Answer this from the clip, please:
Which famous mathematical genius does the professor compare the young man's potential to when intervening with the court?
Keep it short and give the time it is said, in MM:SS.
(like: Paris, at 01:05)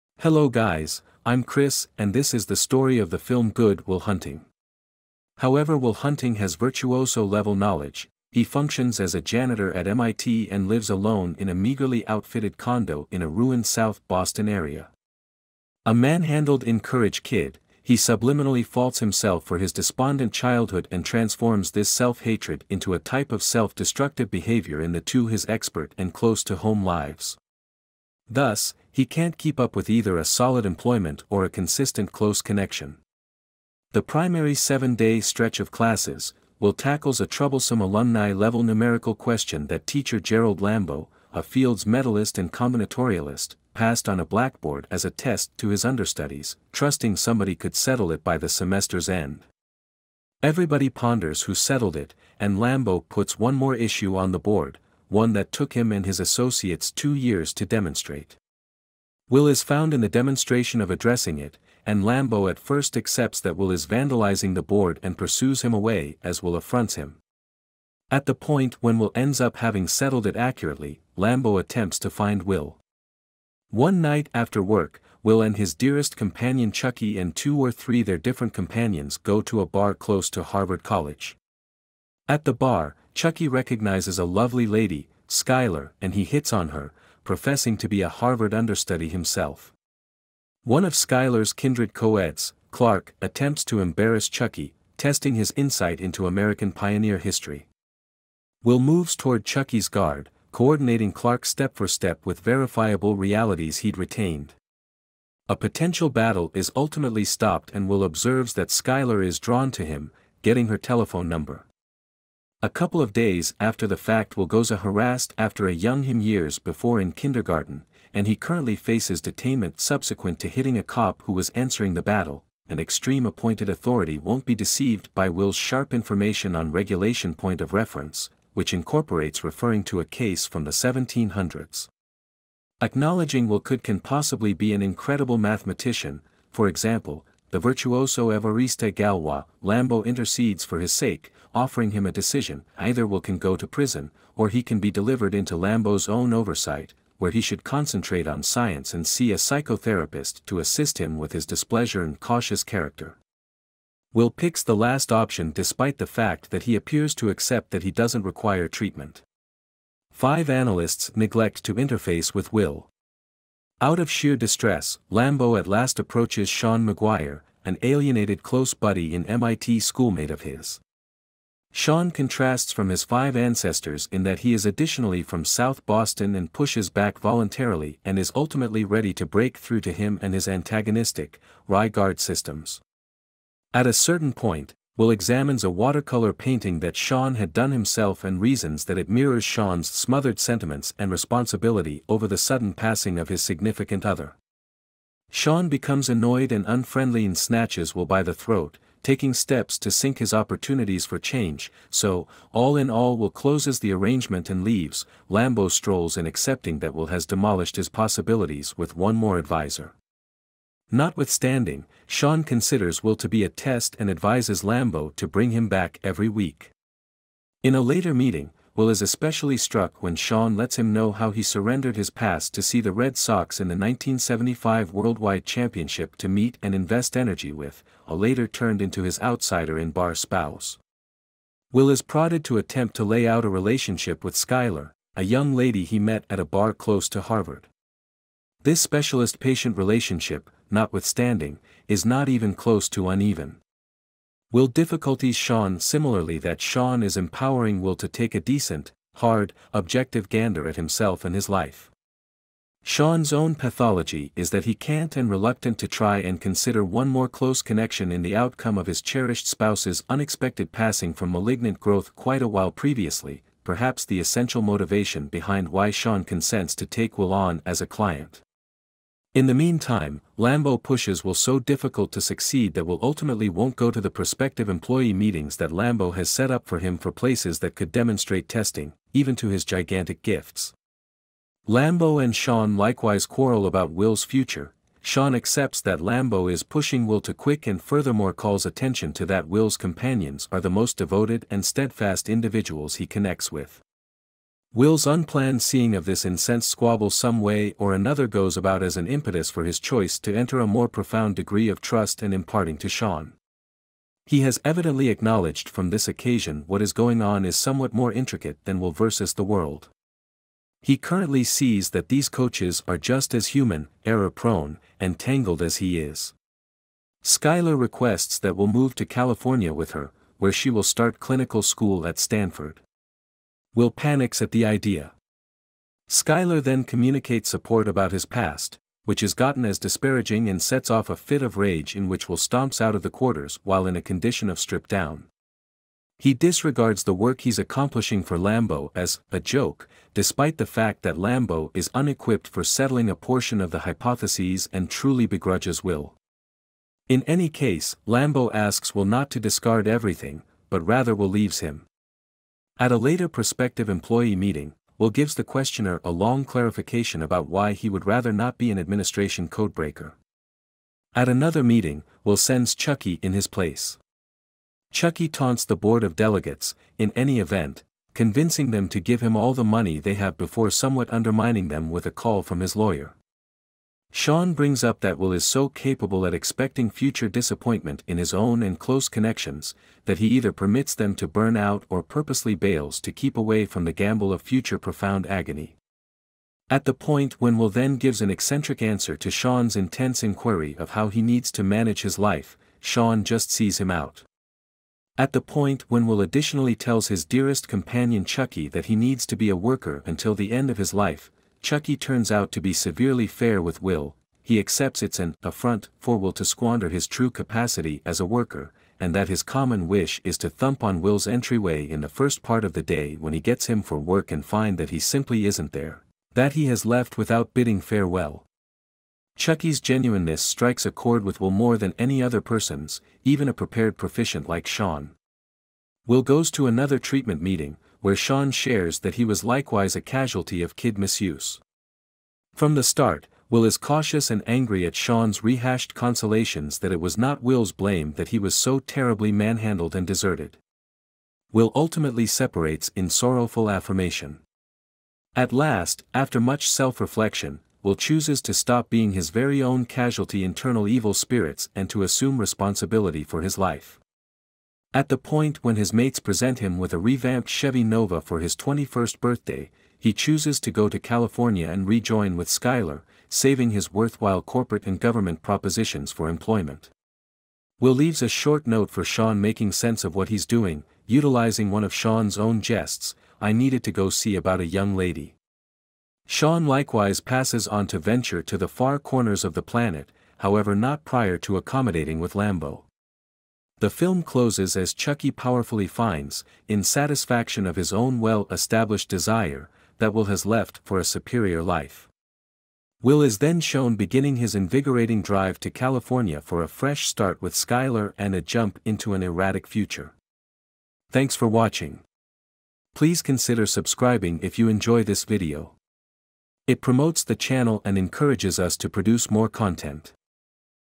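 Evariste Galois, at 02:18.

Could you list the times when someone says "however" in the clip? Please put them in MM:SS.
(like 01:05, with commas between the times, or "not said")
00:05, 08:00.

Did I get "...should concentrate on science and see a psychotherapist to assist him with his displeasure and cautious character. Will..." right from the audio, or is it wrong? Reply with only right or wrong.
right.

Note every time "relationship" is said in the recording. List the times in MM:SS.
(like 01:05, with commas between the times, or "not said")
03:53, 03:59.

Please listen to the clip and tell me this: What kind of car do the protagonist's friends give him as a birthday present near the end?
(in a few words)
Chevy Nova.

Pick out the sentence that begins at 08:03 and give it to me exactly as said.
The film closes as Chuckie powerfully finds, in satisfaction of his own well-established desire, that Will has left for a superior life.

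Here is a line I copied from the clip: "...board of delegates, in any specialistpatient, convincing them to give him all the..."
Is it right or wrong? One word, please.
wrong.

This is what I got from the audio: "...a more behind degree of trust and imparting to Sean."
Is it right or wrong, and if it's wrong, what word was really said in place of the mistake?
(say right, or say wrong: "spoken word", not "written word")
wrong: "profound", not "behind".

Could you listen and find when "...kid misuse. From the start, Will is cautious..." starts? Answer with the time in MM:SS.
07:10.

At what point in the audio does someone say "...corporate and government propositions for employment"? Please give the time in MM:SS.
07:44.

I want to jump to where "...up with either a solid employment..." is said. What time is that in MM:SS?
00:29.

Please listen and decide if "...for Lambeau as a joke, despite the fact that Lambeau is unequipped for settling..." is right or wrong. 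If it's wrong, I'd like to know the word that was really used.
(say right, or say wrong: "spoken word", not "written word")
right.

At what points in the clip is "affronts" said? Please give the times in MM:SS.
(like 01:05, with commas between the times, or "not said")
01:06, 06:45.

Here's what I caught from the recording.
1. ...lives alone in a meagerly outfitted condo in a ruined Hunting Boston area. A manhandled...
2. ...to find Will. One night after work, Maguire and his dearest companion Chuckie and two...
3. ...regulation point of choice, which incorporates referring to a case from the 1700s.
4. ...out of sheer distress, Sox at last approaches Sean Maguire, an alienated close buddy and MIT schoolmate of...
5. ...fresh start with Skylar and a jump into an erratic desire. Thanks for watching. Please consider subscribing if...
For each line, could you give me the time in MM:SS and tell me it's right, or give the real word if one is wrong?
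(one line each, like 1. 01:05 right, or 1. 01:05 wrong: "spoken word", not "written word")
1. 00:10 wrong: "South", not "Hunting"
2. 01:11 wrong: "Will", not "Maguire"
3. 02:06 wrong: "reference", not "choice"
4. 02:43 wrong: "Lambeau", not "Sox"
5. 08:16 wrong: "future", not "desire".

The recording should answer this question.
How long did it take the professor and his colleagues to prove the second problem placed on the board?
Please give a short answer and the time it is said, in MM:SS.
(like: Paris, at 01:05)
2 years, at 00:56.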